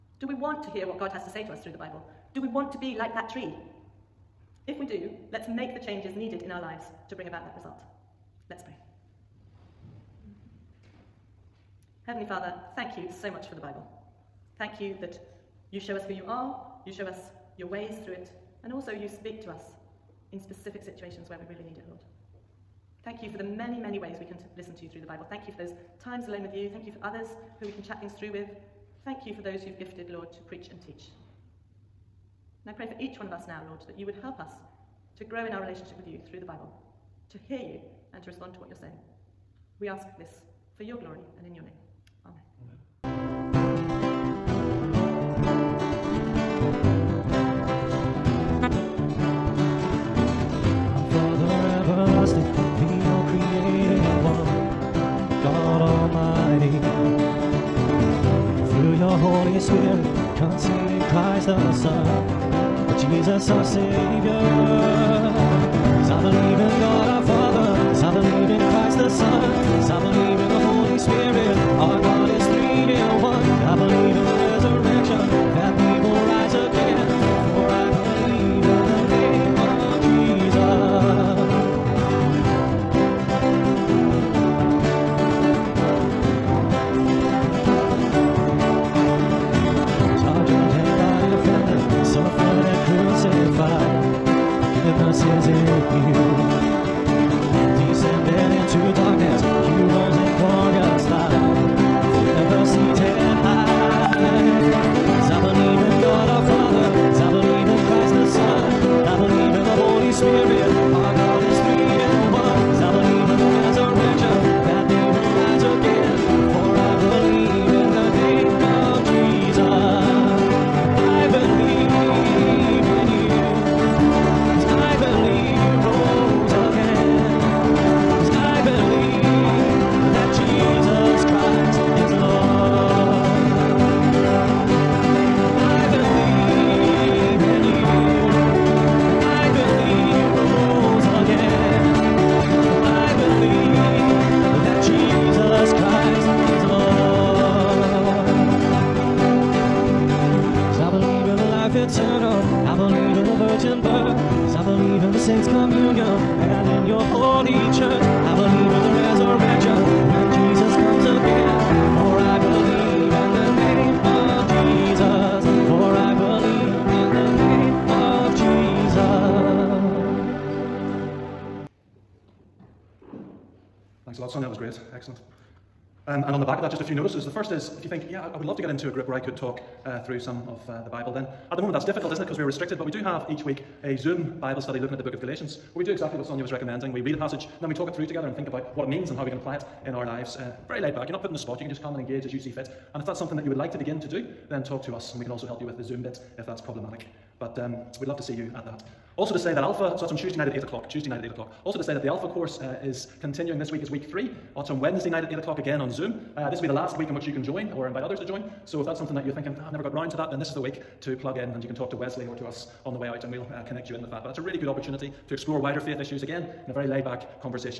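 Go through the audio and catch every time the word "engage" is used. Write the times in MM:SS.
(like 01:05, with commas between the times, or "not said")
03:11.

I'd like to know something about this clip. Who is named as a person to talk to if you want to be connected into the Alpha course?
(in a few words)
Wesley.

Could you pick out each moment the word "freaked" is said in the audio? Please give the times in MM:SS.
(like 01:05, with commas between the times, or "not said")
not said.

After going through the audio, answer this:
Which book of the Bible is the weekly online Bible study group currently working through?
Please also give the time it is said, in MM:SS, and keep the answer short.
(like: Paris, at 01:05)
Galatians, at 03:05.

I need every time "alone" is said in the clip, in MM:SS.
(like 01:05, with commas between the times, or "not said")
00:26.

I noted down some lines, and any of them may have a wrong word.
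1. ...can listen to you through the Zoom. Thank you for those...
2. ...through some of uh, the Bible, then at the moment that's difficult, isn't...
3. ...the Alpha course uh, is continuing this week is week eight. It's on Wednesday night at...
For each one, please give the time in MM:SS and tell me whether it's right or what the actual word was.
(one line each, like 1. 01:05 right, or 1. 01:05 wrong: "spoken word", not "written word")
1. 00:24 wrong: "Bible", not "Zoom"
2. 03:00 right
3. 03:22 wrong: "three", not "eight".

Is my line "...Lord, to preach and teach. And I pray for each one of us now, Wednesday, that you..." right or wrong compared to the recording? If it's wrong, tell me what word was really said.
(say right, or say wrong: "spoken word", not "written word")
wrong: "Lord", not "Wednesday".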